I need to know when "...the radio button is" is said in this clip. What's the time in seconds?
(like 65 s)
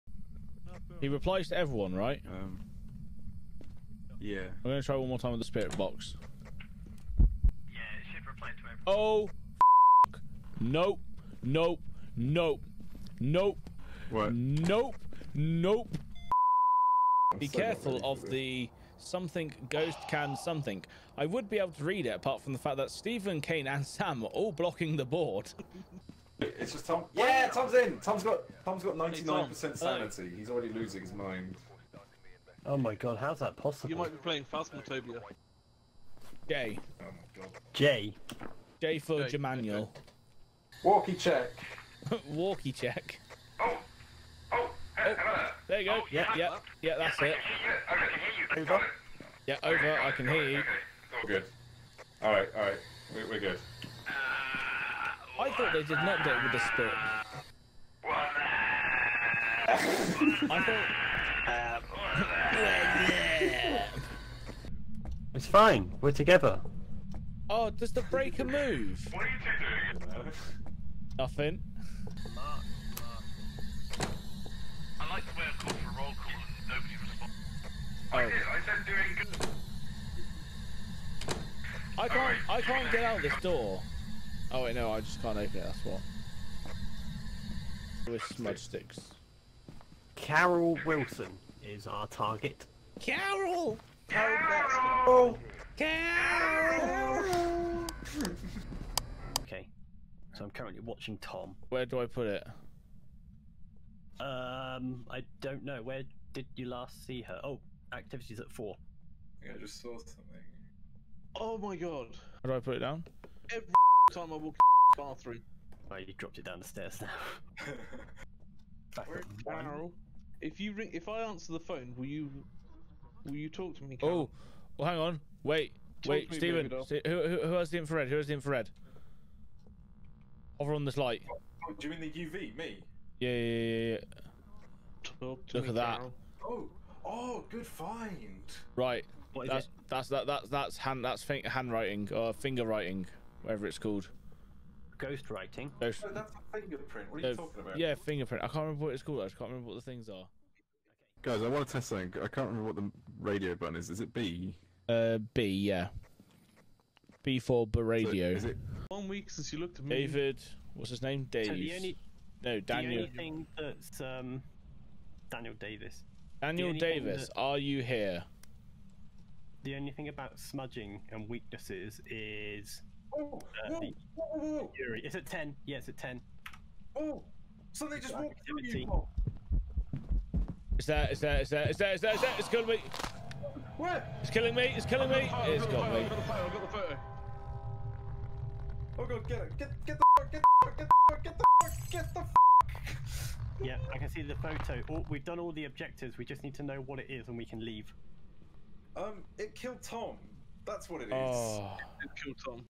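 152 s.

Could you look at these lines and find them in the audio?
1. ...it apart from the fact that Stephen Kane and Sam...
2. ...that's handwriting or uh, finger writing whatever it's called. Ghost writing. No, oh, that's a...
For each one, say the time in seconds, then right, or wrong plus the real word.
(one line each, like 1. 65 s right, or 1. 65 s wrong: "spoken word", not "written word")
1. 22 s right
2. 141 s right.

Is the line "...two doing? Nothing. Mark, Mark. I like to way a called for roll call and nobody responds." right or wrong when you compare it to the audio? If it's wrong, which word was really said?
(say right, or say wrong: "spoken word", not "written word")
right.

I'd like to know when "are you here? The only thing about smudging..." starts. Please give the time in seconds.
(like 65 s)
167 s.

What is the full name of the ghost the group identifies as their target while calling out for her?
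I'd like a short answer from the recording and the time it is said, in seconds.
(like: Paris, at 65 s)
Carol Wilson, at 90 s.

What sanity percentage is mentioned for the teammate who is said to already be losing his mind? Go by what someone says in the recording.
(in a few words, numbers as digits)
99%.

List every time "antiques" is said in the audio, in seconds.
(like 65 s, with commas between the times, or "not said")
not said.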